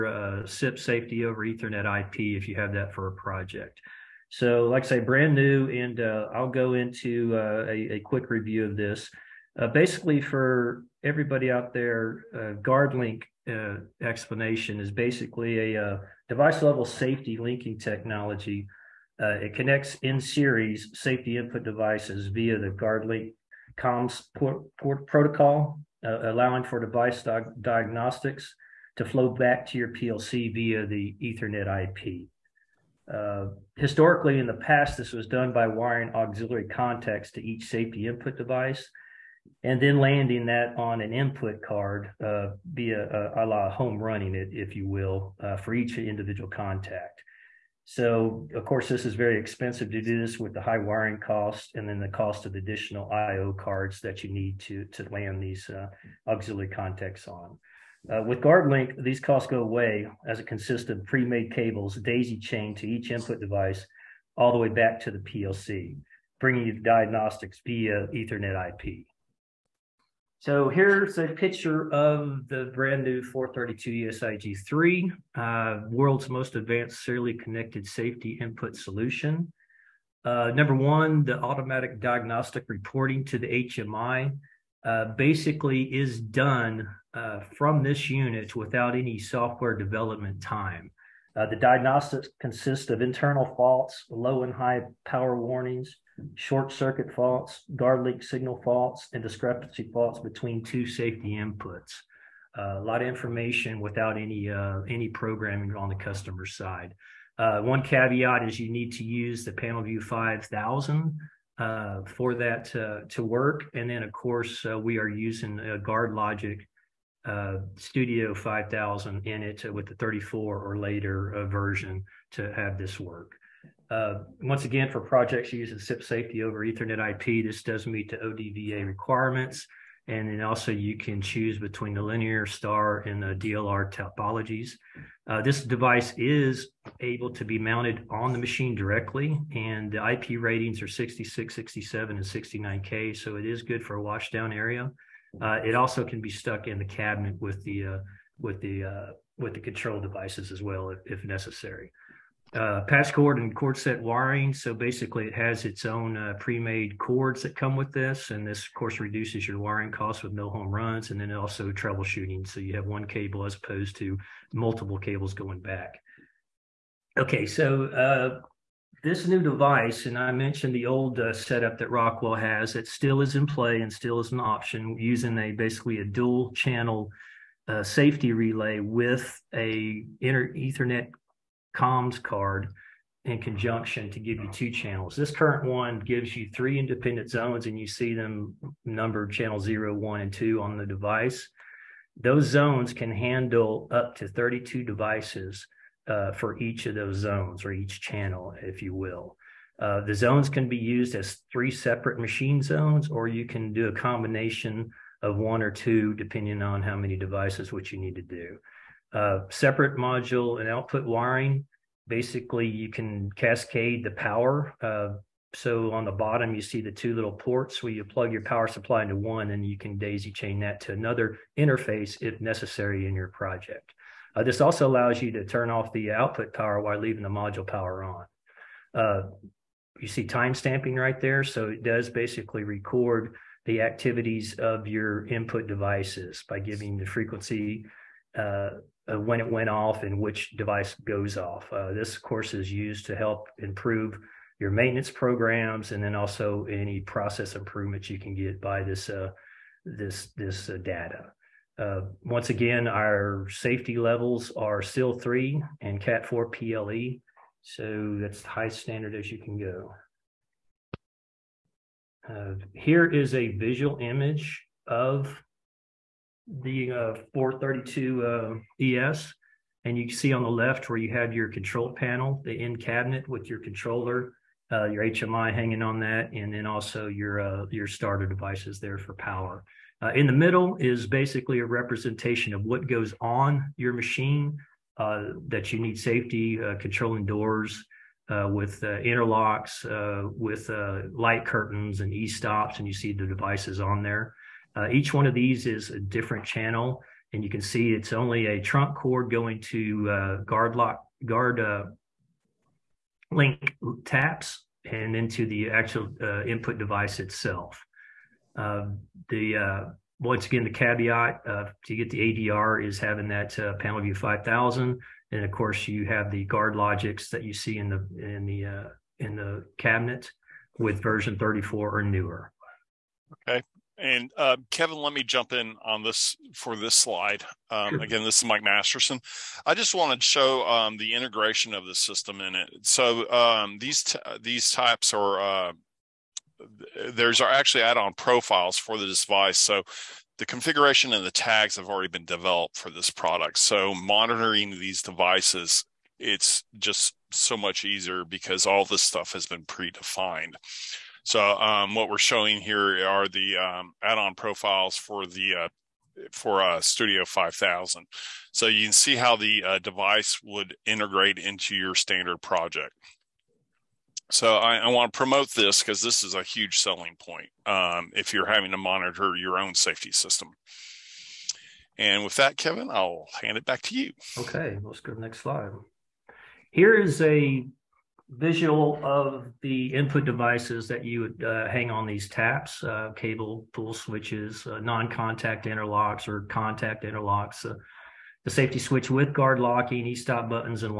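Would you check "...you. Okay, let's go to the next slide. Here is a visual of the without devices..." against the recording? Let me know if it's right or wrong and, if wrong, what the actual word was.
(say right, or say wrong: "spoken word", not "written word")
wrong: "input", not "without".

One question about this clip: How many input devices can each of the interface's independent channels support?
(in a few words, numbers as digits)
32.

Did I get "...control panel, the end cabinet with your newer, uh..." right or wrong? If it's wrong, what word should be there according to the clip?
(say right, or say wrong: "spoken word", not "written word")
wrong: "controller", not "newer".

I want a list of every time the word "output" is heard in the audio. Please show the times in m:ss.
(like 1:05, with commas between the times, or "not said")
3:30, 3:46.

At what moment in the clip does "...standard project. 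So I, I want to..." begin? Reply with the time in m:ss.
6:01.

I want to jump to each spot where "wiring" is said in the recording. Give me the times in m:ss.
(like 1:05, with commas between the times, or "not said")
0:35, 0:50, 2:34, 2:39, 3:31.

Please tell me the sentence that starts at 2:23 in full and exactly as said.
So it is good for a washdown area.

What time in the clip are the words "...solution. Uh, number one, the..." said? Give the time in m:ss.
1:18.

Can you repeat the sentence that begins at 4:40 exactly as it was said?
Uh, in the middle is basically a representation of what goes on your machine uh, that you need safety controlling doors.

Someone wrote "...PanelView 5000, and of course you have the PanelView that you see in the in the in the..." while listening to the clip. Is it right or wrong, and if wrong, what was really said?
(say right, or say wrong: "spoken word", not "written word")
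wrong: "GuardLogix", not "PanelView".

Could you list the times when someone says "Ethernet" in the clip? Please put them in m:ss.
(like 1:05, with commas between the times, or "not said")
0:01, 0:31, 1:08, 2:06, 3:00.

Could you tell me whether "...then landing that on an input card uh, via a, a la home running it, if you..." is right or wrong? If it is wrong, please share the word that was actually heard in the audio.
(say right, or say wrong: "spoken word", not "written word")
right.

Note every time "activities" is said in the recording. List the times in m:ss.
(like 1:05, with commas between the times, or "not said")
3:53.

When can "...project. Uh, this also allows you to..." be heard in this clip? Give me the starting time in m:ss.
3:43.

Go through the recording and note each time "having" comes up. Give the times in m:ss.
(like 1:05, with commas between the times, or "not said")
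5:12, 6:08.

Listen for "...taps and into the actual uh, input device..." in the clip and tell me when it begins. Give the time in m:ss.
5:04.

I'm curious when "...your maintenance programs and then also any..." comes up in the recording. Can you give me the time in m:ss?
4:04.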